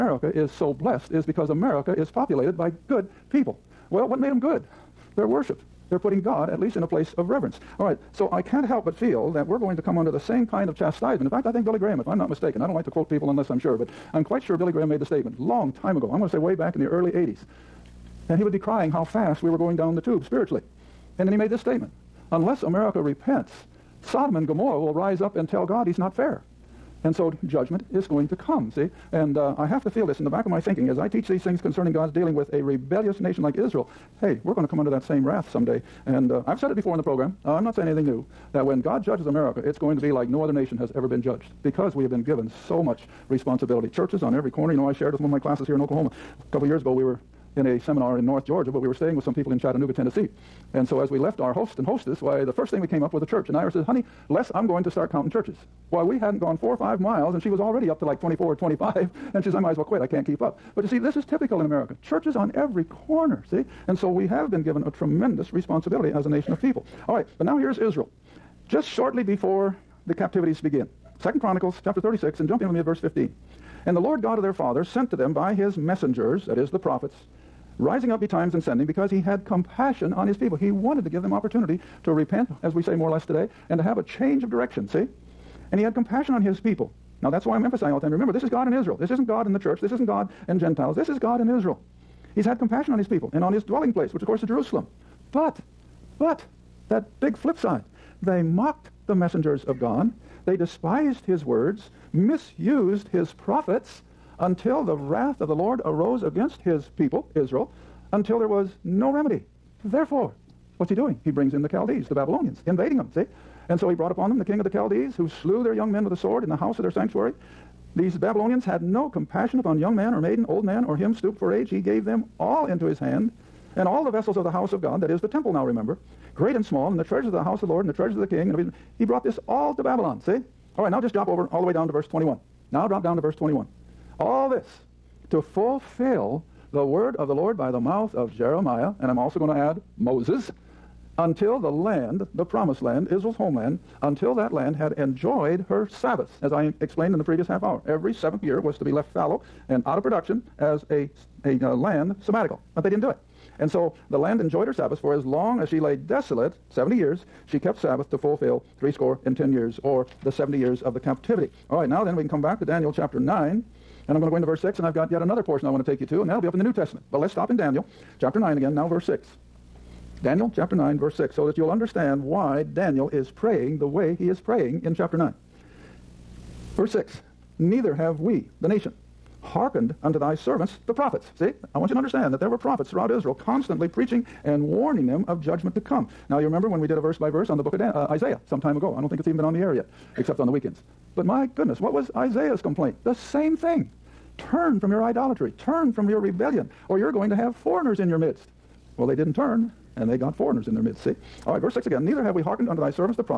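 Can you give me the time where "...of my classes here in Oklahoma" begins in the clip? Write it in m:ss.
0:45.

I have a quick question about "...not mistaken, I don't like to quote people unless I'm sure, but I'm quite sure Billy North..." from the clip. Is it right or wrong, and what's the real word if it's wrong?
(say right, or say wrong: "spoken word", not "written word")
wrong: "Graham", not "North".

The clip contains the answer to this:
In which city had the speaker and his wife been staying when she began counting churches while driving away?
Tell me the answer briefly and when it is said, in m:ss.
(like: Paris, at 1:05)
Chattanooga, Tennessee, at 0:49.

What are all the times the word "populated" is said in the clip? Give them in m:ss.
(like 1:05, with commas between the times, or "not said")
0:02.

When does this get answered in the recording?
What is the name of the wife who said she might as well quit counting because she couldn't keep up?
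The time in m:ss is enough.
0:53.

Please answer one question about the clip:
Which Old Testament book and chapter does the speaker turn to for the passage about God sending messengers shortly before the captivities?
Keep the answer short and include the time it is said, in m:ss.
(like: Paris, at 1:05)
Second Chronicles 36, at 1:11.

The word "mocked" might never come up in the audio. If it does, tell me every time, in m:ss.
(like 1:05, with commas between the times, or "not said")
1:38.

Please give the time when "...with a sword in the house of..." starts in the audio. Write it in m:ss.
1:56.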